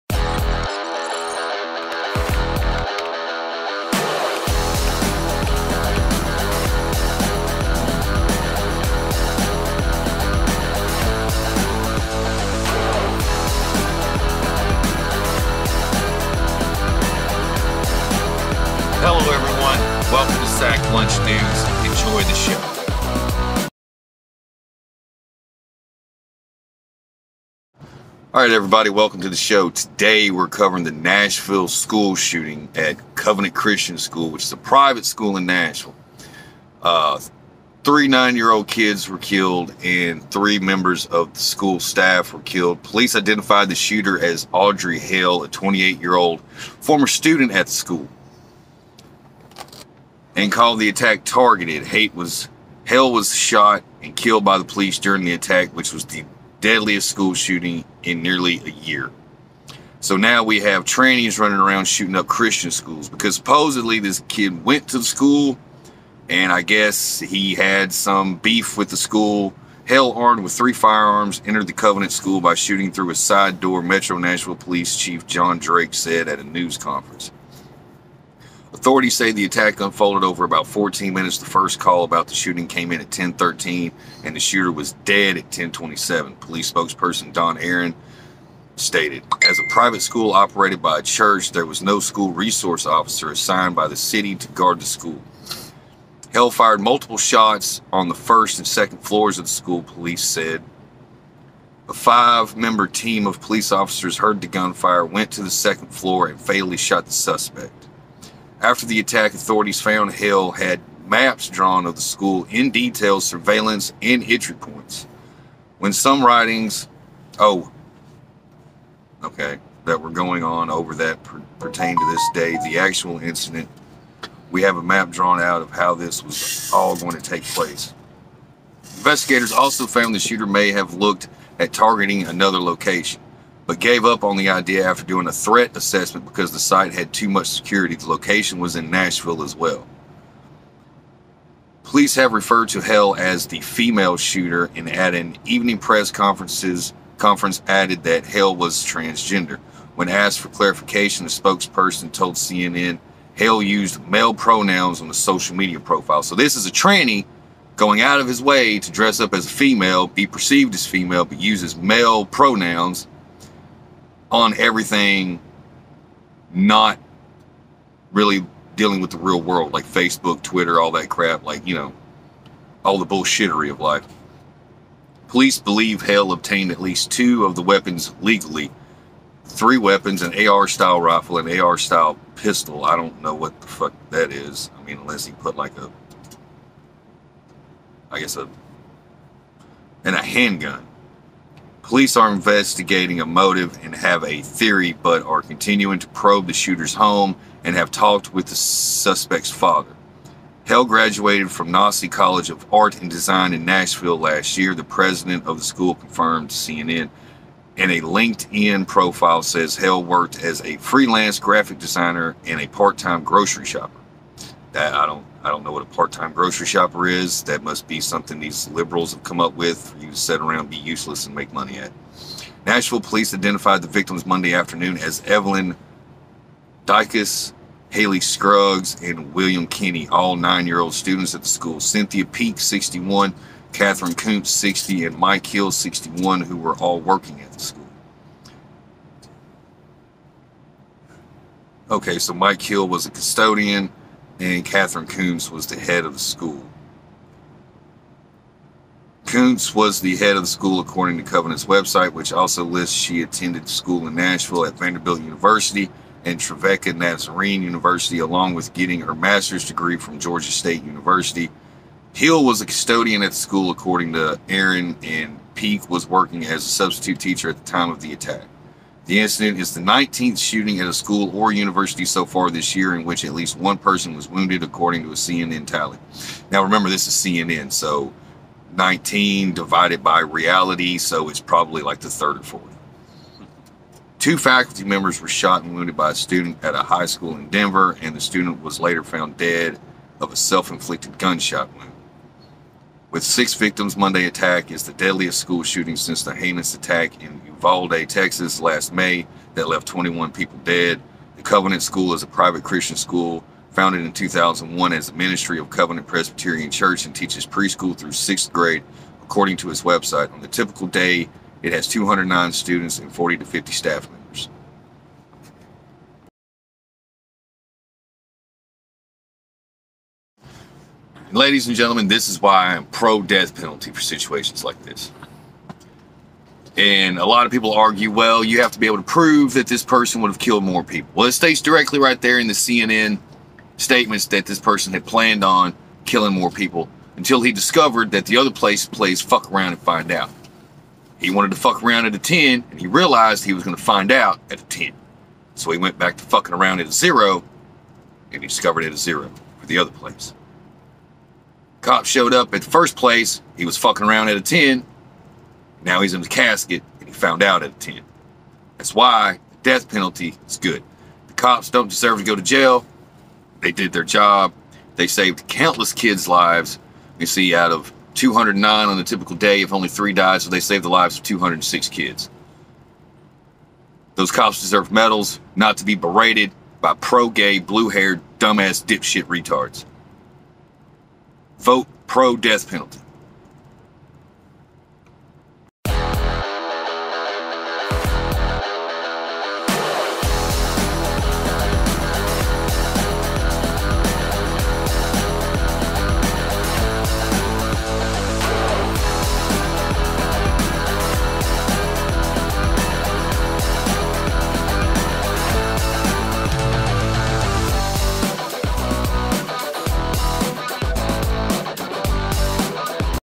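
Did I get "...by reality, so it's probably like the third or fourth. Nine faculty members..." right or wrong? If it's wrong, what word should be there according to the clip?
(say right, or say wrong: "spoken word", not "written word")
wrong: "Two", not "Nine".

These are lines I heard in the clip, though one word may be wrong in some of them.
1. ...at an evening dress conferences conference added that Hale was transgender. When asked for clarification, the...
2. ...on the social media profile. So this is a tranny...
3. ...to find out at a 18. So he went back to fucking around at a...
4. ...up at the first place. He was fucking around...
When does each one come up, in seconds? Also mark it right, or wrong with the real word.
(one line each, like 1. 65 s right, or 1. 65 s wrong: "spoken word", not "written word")
1. 144 s wrong: "press", not "dress"
2. 154 s right
3. 343 s wrong: "10", not "18"
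4. 352 s right.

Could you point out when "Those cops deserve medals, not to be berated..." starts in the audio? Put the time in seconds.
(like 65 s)
374 s.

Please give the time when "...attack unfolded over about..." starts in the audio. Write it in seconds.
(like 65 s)
79 s.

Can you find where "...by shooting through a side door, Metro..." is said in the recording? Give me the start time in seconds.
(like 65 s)
72 s.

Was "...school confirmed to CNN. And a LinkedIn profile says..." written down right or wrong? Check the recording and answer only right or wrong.
right.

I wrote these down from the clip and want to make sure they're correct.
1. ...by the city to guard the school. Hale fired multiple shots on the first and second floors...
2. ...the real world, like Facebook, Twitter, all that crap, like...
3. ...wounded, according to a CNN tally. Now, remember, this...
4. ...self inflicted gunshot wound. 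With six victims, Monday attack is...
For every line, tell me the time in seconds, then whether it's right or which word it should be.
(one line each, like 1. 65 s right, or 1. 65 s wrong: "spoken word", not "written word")
1. 93 s right
2. 169 s right
3. 274 s right
4. 290 s right.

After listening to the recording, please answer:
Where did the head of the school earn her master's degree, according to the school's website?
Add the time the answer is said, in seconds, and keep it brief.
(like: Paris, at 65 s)
Georgia State University, at 260 s.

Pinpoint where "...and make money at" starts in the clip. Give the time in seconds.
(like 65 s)
221 s.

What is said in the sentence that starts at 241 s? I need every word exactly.
Okay, so Mike Hill was a custodian and Catherine Koonce was the head of the school.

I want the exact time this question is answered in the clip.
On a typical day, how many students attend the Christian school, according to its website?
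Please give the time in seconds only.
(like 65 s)
311 s.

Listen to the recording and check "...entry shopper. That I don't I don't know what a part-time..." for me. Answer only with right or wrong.
wrong.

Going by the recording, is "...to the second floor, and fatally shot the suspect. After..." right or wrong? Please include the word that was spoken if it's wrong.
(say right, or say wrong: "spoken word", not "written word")
right.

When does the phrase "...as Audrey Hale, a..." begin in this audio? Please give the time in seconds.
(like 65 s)
44 s.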